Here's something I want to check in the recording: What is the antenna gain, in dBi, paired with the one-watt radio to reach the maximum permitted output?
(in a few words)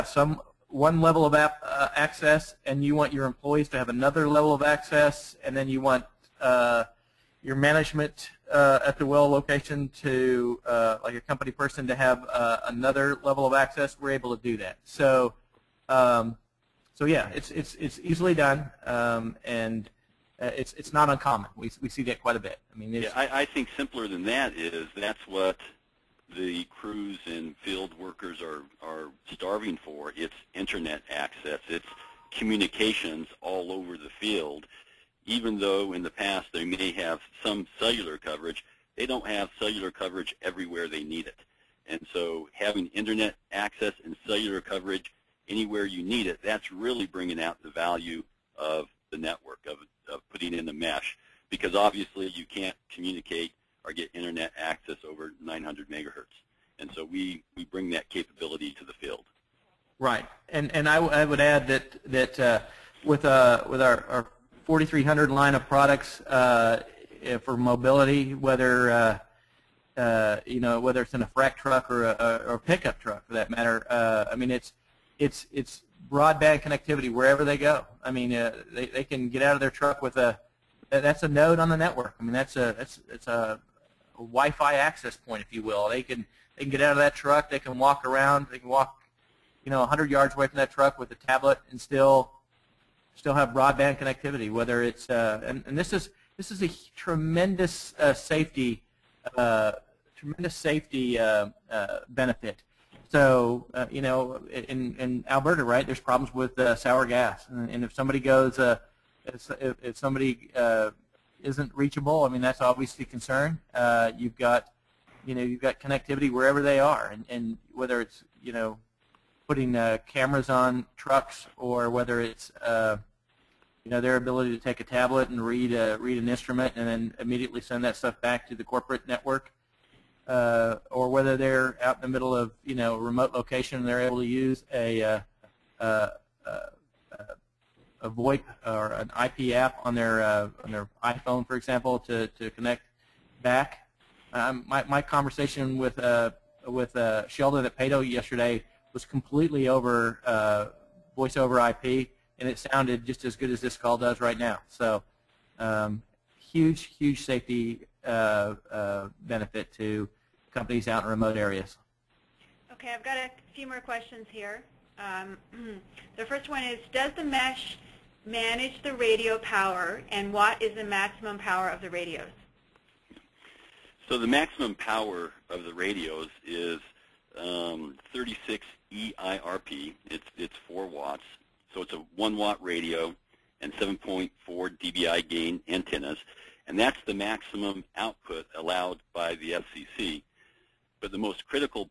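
7.4 dBi.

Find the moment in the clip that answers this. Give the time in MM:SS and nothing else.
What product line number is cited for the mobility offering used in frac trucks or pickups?
01:04.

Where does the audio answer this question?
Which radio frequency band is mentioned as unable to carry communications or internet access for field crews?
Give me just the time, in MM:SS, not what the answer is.
00:55.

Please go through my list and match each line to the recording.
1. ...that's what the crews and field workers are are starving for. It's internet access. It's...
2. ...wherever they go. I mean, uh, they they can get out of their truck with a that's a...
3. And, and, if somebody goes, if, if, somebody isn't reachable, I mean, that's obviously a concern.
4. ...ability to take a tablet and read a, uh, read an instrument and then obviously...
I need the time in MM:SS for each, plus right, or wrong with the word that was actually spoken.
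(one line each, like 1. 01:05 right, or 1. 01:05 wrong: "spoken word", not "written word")
1. 00:24 right
2. 01:17 right
3. 01:47 right
4. 02:04 wrong: "immediately", not "obviously".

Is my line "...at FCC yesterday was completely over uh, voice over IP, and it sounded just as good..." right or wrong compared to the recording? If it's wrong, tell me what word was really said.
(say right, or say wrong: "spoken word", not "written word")
wrong: "Peyto", not "FCC".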